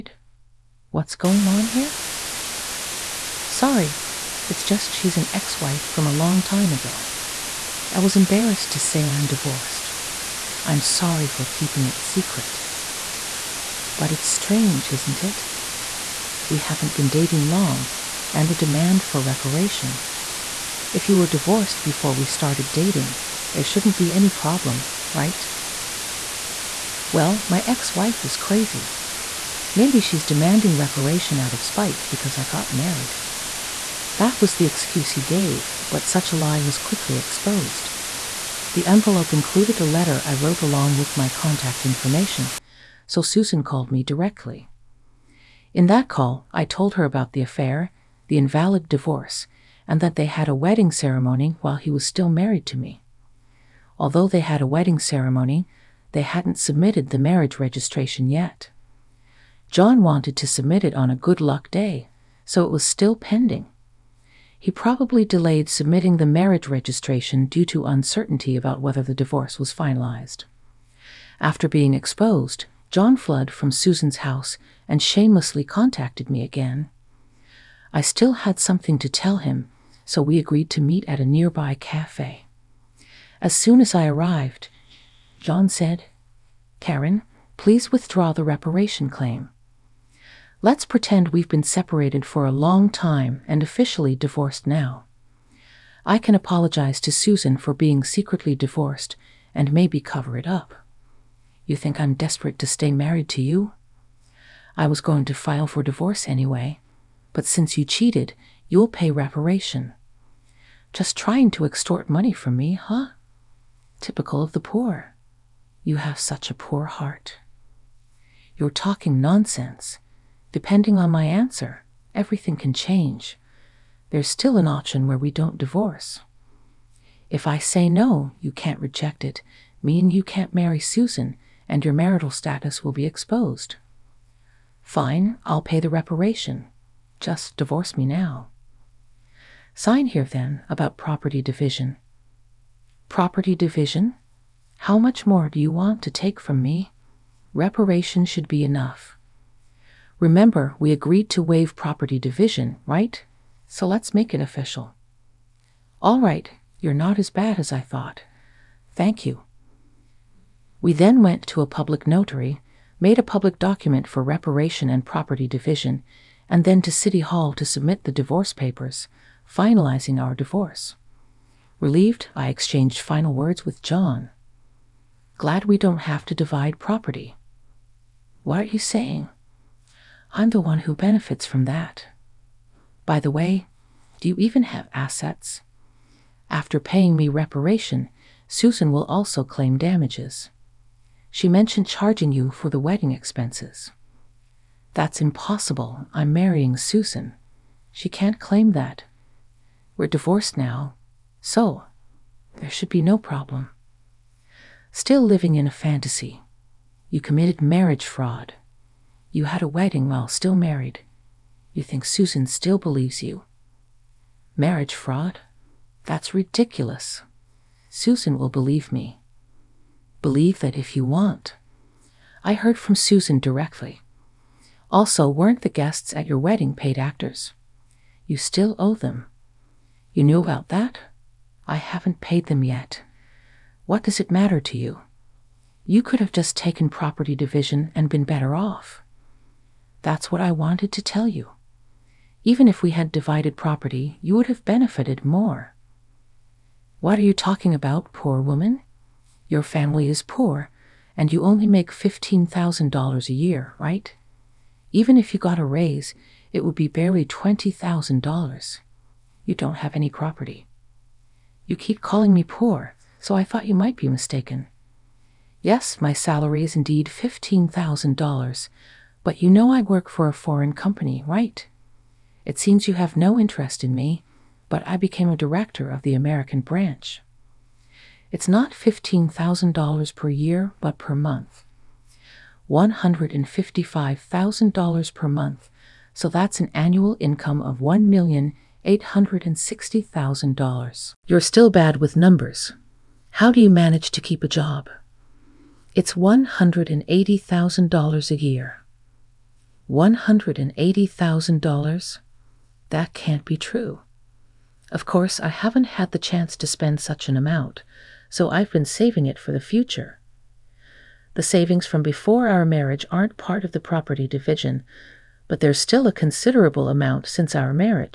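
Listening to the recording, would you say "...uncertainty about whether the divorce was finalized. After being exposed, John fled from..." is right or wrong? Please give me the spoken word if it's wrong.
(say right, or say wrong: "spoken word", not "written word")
right.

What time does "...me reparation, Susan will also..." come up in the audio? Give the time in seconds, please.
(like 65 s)
187 s.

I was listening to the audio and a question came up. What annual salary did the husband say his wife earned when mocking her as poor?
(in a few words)
$15,000.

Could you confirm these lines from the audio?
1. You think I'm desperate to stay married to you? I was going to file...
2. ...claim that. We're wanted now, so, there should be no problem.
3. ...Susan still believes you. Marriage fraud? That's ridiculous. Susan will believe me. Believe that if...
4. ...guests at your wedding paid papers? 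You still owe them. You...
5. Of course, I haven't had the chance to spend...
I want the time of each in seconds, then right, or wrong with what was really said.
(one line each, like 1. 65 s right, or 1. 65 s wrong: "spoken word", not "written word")
1. 101 s right
2. 198 s wrong: "divorced", not "wanted"
3. 212 s right
4. 225 s wrong: "actors", not "papers"
5. 304 s right.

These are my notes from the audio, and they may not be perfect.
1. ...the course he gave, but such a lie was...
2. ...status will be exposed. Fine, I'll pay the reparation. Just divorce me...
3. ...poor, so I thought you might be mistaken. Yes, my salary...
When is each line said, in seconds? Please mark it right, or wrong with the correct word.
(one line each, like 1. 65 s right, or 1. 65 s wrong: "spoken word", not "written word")
1. 34 s wrong: "excuse", not "course"
2. 132 s right
3. 262 s right.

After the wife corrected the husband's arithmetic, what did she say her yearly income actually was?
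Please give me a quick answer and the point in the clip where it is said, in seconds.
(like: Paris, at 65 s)
$180,000, at 296 s.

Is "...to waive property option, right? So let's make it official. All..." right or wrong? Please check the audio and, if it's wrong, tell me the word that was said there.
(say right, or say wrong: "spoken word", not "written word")
wrong: "division", not "option".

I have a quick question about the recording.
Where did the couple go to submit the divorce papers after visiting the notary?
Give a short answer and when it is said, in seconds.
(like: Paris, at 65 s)
City Hall, at 166 s.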